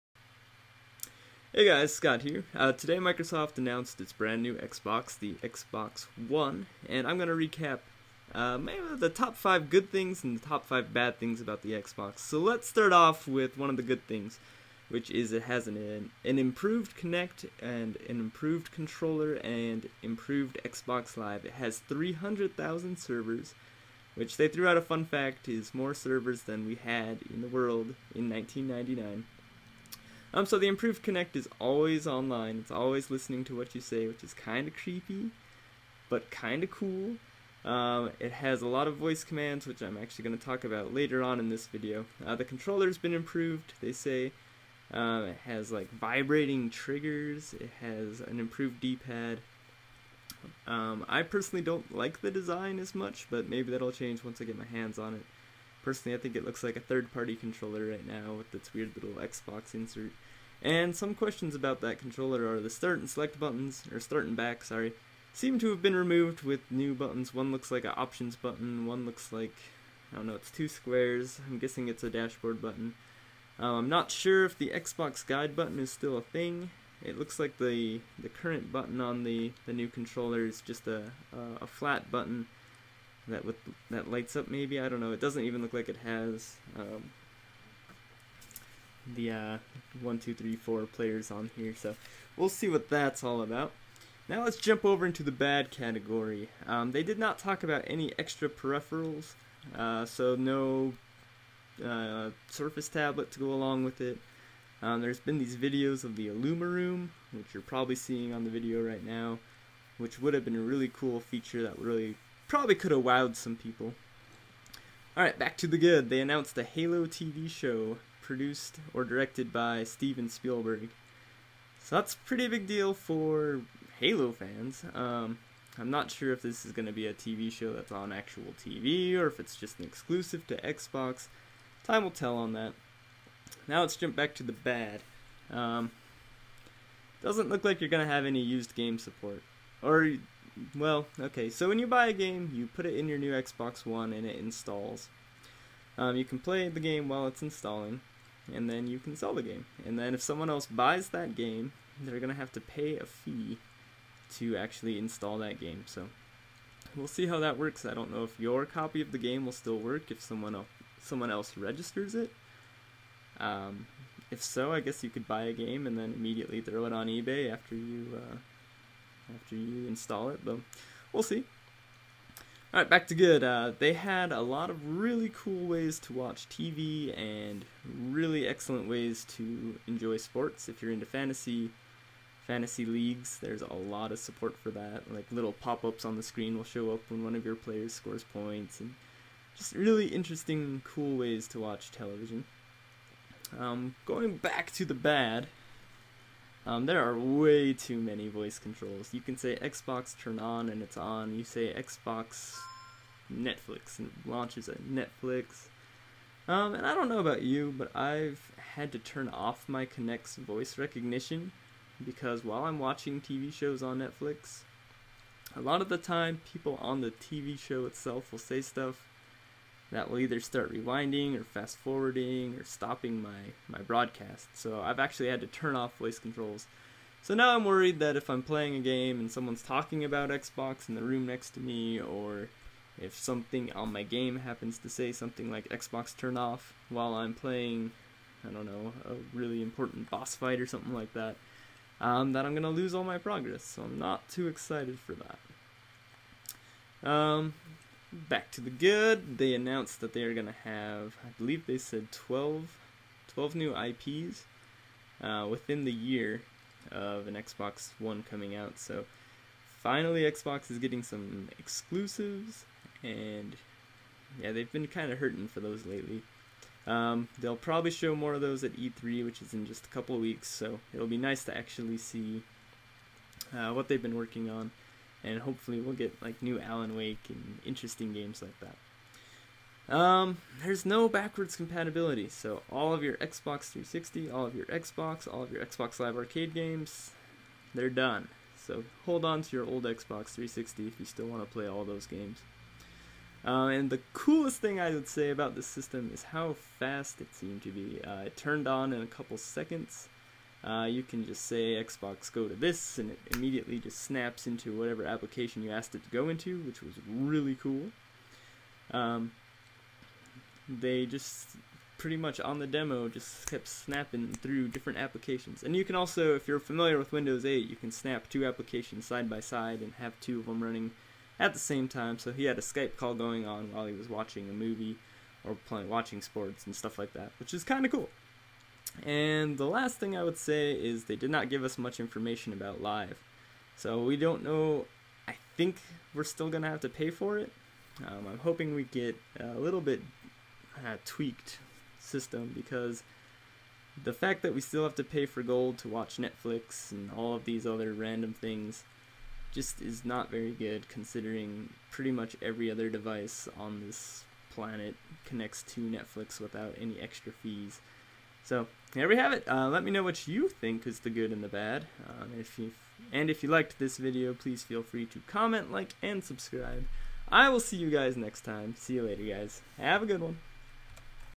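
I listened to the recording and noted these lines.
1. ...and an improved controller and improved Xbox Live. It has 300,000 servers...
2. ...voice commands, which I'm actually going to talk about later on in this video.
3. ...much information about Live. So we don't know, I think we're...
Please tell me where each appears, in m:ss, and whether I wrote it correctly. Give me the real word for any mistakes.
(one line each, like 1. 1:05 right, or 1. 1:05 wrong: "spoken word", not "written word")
1. 0:17 right
2. 0:38 right
3. 5:31 right.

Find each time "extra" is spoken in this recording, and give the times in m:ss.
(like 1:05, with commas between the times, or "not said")
1:38, 5:56.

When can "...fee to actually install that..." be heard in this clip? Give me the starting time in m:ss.
2:33.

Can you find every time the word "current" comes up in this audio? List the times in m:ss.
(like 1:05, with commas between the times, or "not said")
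1:18.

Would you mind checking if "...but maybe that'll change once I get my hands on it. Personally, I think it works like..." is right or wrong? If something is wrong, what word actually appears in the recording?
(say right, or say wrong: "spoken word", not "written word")
wrong: "looks", not "works".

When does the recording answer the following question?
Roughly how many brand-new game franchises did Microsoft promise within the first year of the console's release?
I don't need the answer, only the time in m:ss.
4:13.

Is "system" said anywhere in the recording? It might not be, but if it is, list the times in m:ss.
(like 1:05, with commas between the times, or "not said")
4:55, 5:41.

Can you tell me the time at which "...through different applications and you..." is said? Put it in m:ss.
5:14.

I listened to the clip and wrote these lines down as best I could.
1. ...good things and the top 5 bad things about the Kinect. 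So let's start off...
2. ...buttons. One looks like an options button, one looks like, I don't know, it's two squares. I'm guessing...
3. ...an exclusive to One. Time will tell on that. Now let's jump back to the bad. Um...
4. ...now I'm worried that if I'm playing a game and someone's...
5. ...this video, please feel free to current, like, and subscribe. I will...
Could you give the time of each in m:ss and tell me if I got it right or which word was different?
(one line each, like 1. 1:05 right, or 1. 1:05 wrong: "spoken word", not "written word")
1. 0:09 wrong: "Xbox", not "Kinect"
2. 1:06 right
3. 2:09 wrong: "Xbox", not "One"
4. 3:47 right
5. 6:03 wrong: "comment", not "current".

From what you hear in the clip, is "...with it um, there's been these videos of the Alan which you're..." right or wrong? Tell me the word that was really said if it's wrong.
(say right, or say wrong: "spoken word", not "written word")
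wrong: "Room", not "Alan".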